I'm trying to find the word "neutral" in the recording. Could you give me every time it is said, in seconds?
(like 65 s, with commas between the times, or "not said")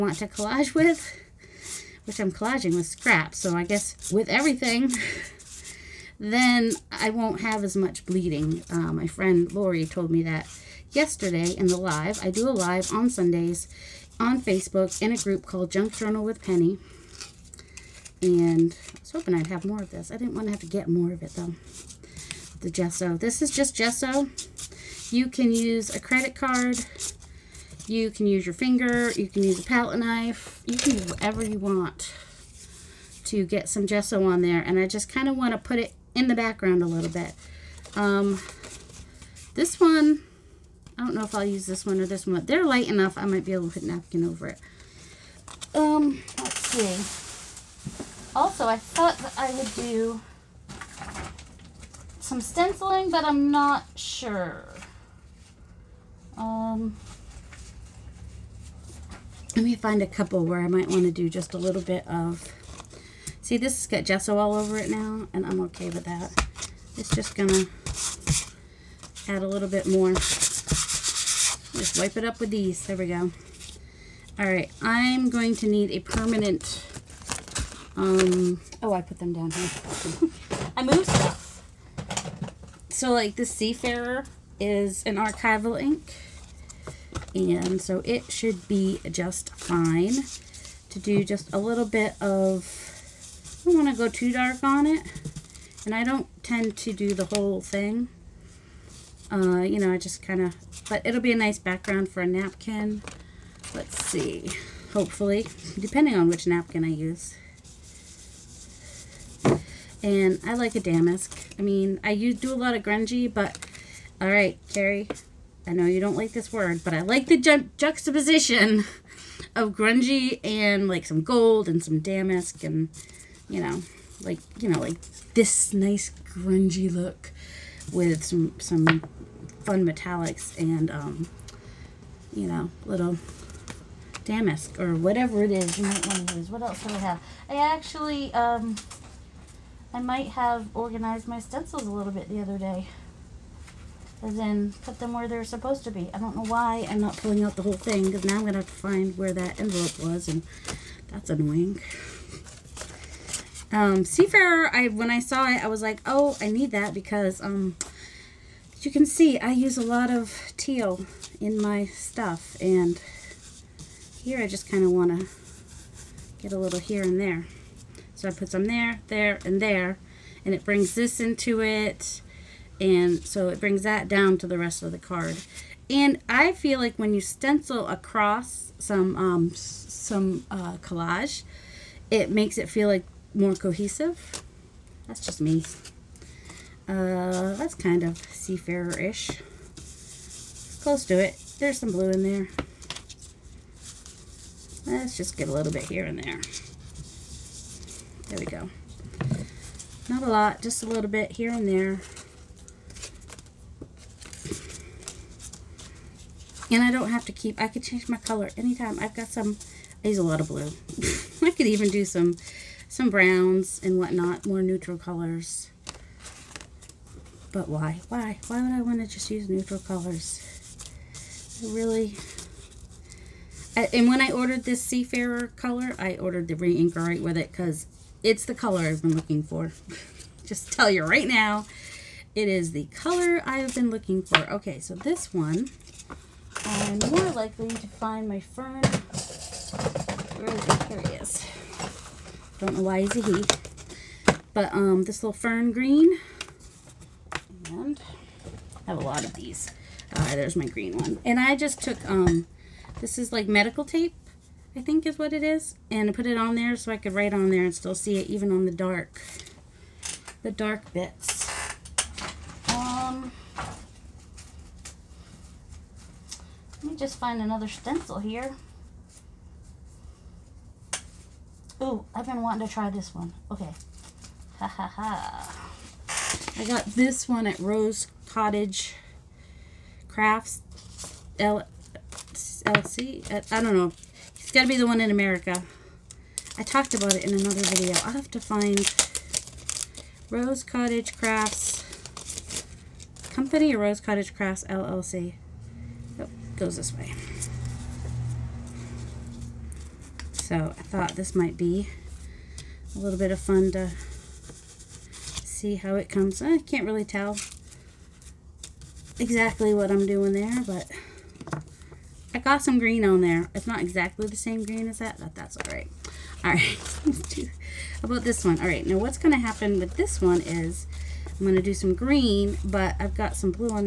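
214 s, 219 s.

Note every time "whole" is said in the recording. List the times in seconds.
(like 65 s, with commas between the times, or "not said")
97 s, 147 s.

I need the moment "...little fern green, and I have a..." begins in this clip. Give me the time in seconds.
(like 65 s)
245 s.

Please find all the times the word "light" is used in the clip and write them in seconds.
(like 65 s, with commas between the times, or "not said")
42 s.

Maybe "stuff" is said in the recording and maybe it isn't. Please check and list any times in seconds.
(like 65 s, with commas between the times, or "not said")
81 s, 161 s.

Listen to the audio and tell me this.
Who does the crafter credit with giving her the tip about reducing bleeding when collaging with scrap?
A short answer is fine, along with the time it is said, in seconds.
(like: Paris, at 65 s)
Lori, at 9 s.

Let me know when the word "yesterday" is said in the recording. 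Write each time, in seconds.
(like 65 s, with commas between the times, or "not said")
10 s.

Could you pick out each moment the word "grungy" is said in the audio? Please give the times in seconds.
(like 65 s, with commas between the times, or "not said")
112 s, 119 s, 126 s.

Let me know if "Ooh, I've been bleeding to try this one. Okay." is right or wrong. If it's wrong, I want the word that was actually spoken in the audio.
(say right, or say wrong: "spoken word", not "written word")
wrong: "wanting", not "bleeding".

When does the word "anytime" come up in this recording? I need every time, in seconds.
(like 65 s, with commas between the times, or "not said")
208 s.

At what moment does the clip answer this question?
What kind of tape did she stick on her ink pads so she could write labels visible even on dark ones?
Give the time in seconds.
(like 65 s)
253 s.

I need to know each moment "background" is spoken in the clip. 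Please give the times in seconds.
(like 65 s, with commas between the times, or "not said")
36 s, 101 s.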